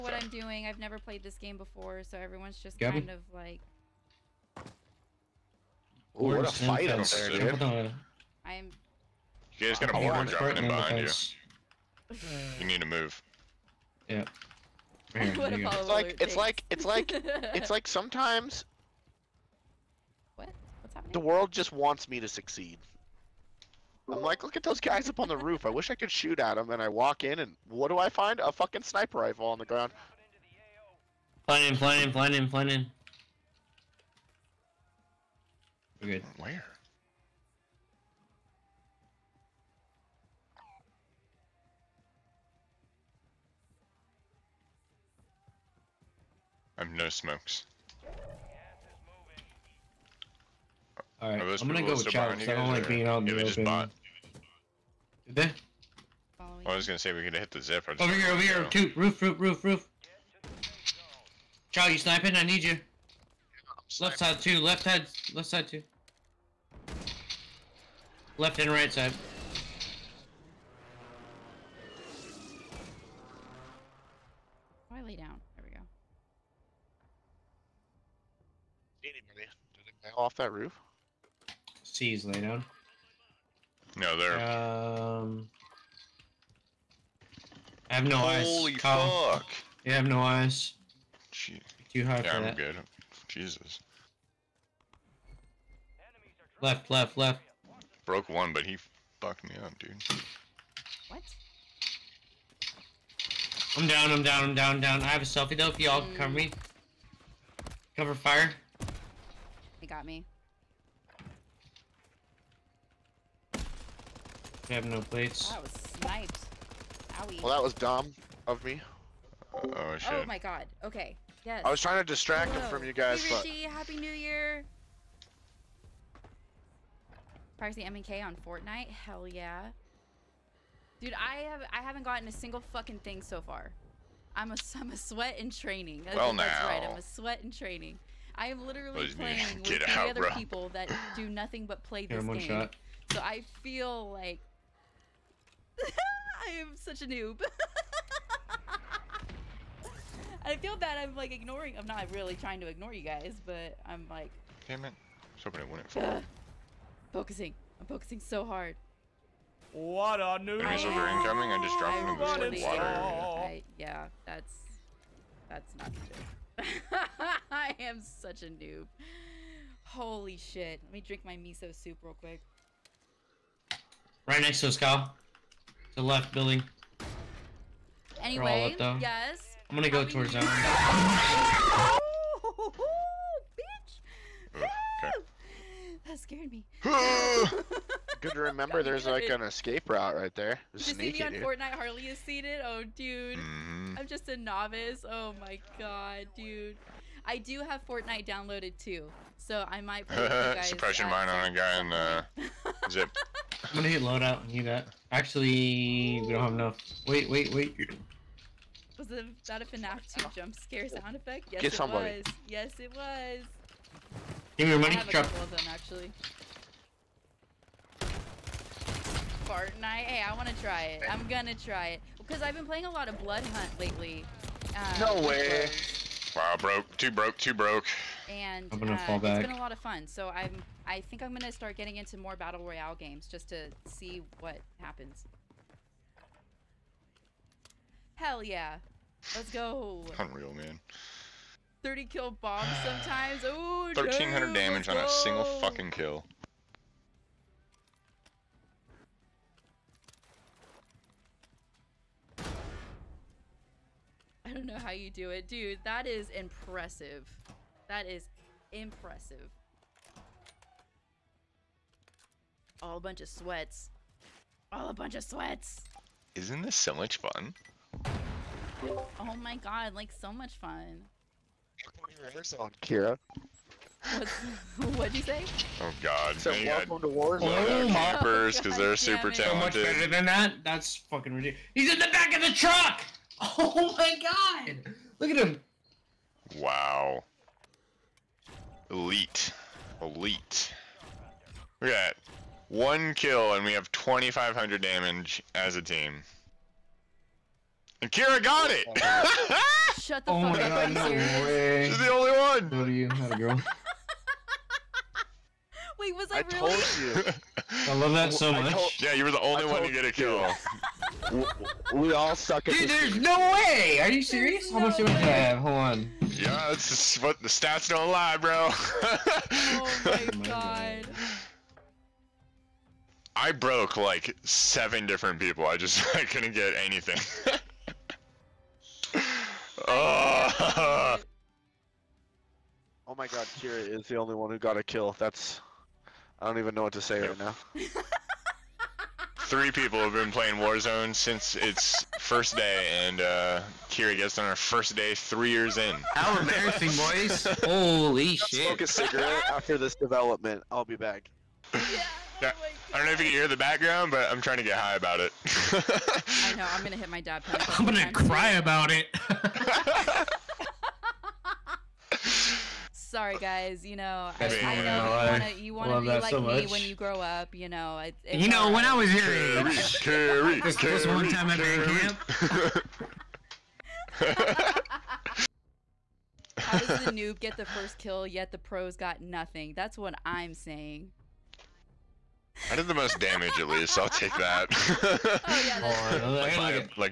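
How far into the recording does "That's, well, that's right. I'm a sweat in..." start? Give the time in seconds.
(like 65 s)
136 s.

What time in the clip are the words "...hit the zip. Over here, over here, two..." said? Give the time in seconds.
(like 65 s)
57 s.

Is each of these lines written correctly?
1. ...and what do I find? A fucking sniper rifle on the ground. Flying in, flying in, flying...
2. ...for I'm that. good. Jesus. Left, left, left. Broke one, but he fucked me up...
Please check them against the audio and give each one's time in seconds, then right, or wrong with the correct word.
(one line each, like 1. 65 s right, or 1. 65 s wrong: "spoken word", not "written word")
1. 27 s right
2. 92 s right.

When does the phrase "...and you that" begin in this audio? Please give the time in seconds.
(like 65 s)
204 s.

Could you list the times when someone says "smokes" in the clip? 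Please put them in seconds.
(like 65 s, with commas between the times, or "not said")
47 s, 348 s.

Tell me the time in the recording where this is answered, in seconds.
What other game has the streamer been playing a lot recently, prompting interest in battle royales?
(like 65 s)
223 s.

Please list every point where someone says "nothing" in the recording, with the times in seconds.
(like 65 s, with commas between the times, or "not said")
141 s, 379 s.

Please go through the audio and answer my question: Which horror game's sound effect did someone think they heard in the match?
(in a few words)
FNAF 2.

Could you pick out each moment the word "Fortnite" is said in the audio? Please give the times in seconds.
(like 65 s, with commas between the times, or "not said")
128 s, 191 s, 197 s, 219 s.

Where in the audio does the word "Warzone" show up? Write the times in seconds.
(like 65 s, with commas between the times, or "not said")
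277 s, 340 s.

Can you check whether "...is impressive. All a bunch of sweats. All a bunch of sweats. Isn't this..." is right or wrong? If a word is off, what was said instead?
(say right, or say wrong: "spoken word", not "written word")
right.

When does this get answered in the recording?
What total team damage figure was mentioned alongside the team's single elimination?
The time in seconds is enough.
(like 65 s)
293 s.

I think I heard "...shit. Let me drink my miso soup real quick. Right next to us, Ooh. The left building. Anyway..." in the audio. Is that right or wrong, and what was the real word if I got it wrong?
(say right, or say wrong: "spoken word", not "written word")
wrong: "Kyle", not "Ooh".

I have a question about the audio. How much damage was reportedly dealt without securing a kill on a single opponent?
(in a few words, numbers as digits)
1300.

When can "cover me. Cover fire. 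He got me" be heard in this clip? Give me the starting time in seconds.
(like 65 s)
106 s.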